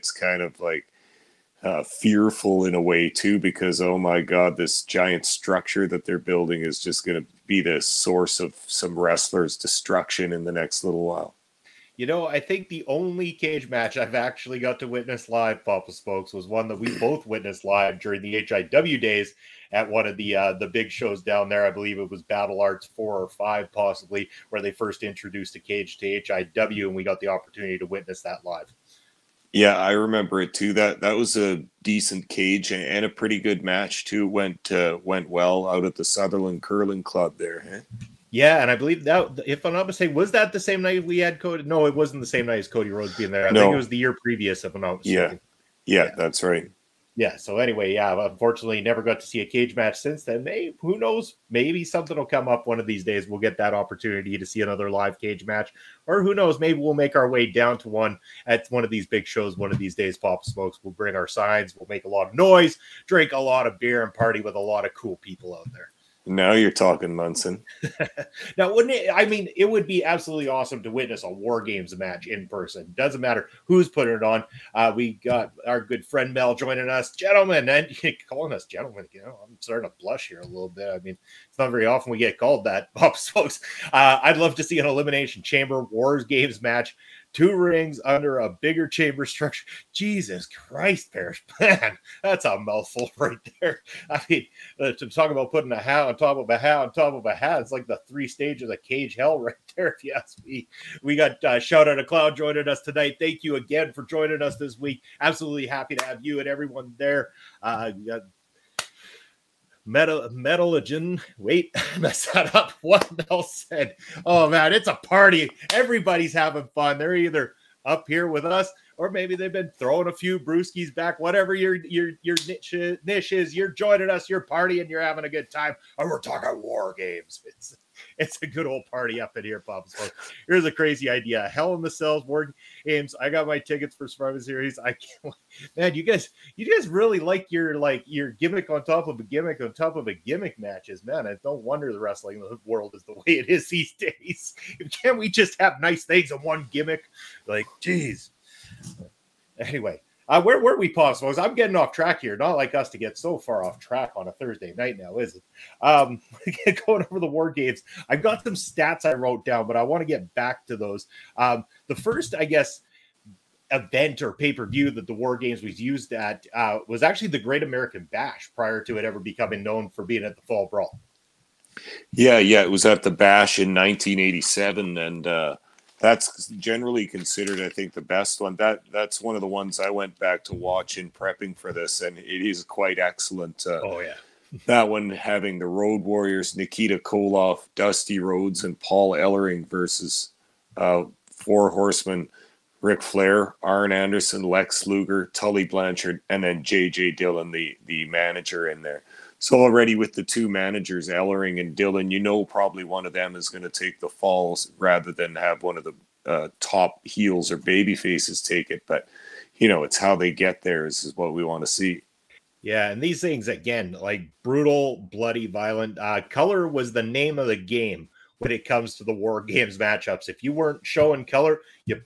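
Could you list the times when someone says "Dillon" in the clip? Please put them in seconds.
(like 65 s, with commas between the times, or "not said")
197 s, 201 s.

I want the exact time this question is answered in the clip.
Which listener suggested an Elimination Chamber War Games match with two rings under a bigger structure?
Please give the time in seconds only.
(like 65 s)
91 s.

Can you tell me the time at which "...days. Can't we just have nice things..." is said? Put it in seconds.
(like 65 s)
143 s.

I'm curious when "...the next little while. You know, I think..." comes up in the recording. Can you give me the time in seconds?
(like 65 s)
10 s.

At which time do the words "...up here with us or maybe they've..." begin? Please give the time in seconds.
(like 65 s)
117 s.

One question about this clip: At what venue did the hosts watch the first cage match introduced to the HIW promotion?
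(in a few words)
Sutherland Curling Club.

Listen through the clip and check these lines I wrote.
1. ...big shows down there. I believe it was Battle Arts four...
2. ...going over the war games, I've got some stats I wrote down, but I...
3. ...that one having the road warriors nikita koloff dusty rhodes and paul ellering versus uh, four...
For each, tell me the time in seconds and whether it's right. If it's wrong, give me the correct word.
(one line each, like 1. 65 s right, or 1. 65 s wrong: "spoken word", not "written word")
1. 20 s right
2. 156 s right
3. 184 s right.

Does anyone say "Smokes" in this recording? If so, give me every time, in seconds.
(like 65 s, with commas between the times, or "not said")
15 s, 60 s.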